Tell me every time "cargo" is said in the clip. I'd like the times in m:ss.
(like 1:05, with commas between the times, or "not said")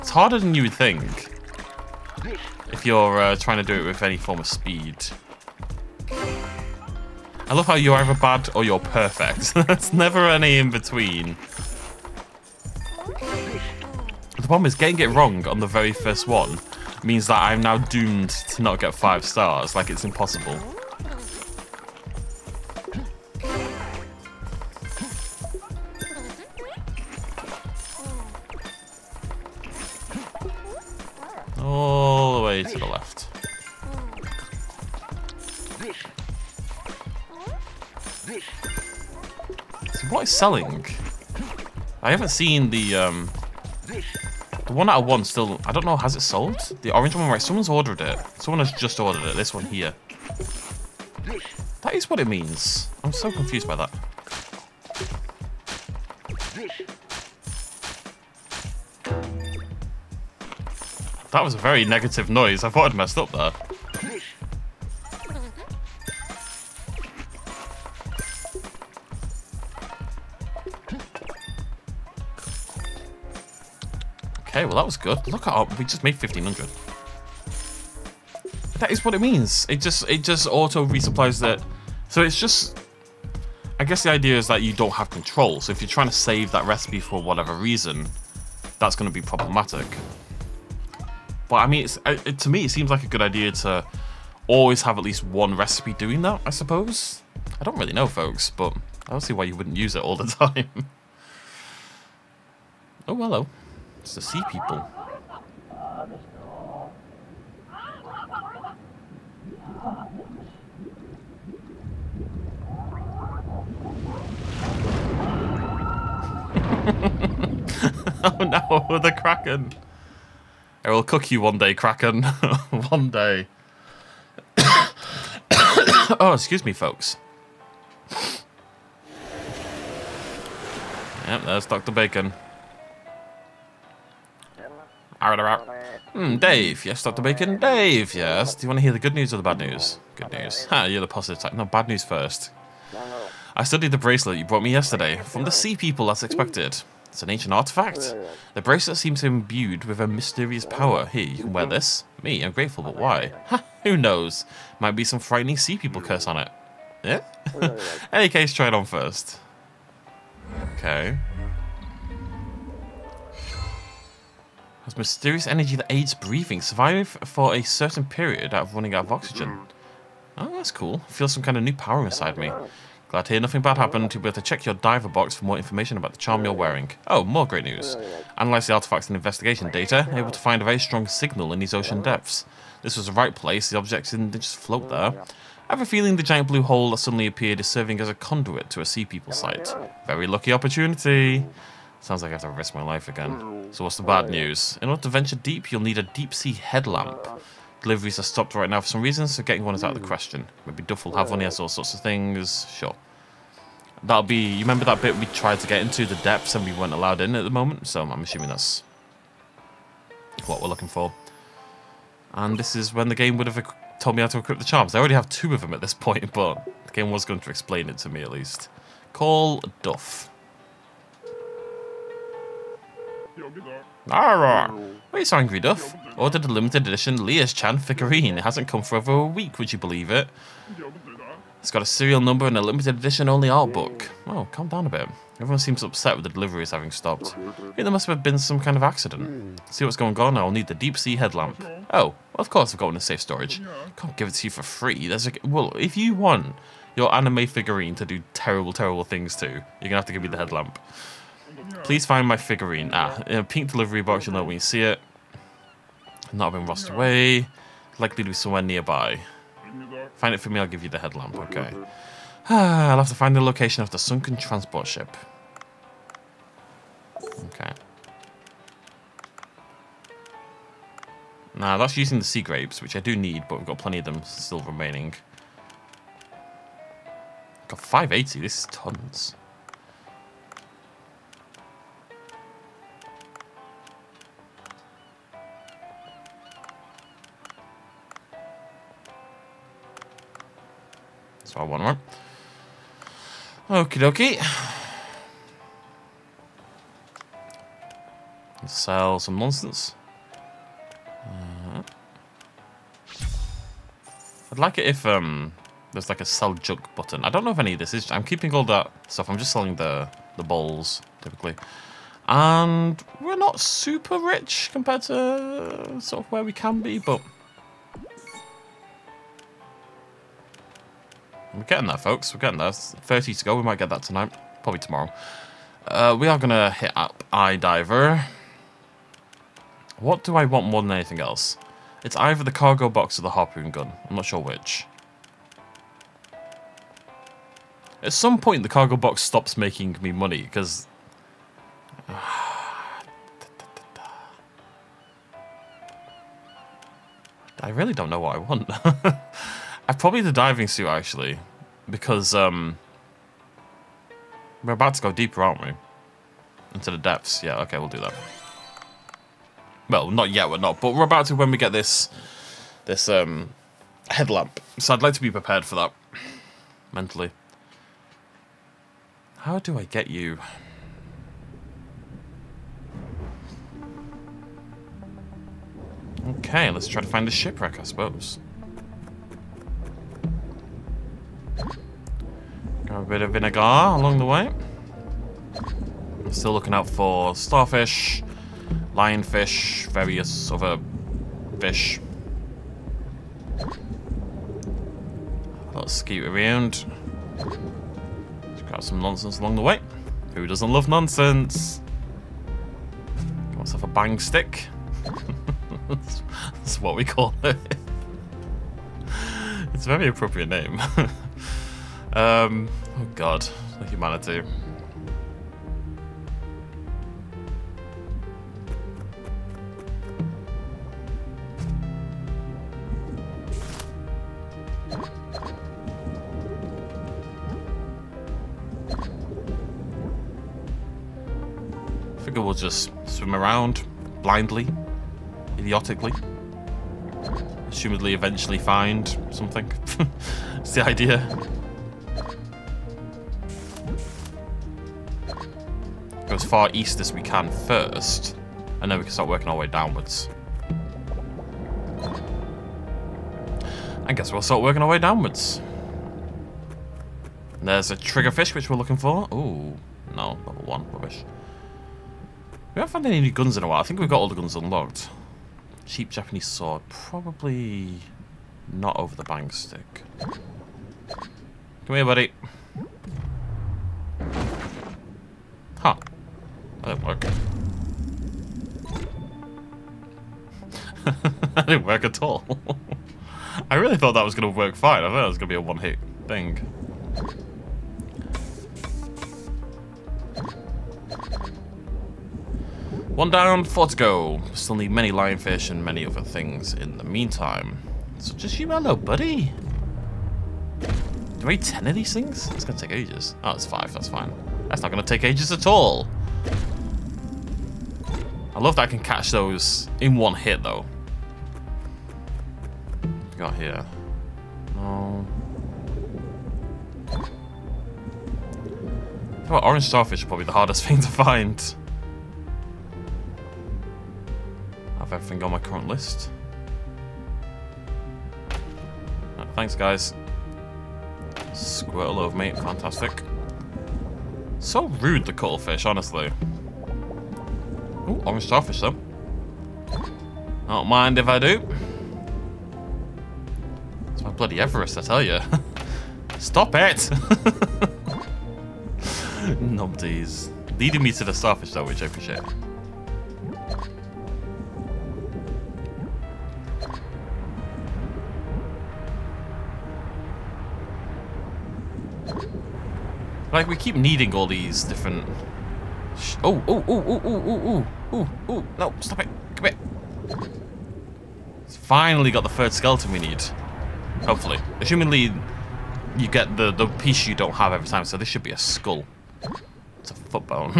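5:32, 5:38.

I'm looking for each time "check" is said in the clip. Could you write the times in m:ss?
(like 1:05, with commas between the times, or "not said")
2:54.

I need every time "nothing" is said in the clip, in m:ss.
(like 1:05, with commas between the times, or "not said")
2:53.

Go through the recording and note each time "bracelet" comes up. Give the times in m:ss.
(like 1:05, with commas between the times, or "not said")
2:23, 2:28.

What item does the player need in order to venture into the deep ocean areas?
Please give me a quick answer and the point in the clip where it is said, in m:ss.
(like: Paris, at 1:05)
deep-sea headlamp, at 3:16.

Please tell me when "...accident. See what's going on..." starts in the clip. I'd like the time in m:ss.
3:58.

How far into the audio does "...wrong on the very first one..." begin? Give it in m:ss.
0:15.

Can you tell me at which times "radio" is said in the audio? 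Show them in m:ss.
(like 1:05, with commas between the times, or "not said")
not said.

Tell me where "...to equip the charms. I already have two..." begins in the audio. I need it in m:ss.
3:34.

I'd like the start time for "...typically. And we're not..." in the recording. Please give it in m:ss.
5:11.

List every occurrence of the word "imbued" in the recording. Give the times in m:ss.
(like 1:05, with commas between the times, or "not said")
2:29.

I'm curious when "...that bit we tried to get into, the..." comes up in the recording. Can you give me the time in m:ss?
3:24.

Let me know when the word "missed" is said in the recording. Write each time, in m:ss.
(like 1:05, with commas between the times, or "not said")
not said.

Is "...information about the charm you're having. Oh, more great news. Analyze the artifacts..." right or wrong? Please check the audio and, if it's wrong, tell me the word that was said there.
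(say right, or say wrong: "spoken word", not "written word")
wrong: "wearing", not "having".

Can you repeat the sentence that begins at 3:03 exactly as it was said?
The objects didn't just float there.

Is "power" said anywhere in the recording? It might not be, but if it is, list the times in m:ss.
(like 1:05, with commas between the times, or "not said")
2:30, 2:51.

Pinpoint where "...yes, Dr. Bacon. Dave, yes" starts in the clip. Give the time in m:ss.
2:16.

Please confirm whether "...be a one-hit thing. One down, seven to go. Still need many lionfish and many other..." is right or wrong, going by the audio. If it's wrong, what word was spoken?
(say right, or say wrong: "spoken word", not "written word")
wrong: "four", not "seven".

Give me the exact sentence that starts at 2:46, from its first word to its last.
Survive for a certain period out of running out of oxygen.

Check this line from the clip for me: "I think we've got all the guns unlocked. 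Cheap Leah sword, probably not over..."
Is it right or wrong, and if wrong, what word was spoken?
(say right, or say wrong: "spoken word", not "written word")
wrong: "Japanese", not "Leah".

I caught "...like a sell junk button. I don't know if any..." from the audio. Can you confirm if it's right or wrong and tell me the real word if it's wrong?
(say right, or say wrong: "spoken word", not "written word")
right.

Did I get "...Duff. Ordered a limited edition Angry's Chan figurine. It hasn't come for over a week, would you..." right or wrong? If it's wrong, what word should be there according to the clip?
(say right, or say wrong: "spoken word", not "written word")
wrong: "Leah", not "Angry".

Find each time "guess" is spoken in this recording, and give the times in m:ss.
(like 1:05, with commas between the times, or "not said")
1:23, 7:34.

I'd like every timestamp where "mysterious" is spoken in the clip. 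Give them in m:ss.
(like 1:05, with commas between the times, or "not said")
2:30, 2:44.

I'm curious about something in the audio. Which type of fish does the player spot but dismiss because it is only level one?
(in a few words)
Triggerfish.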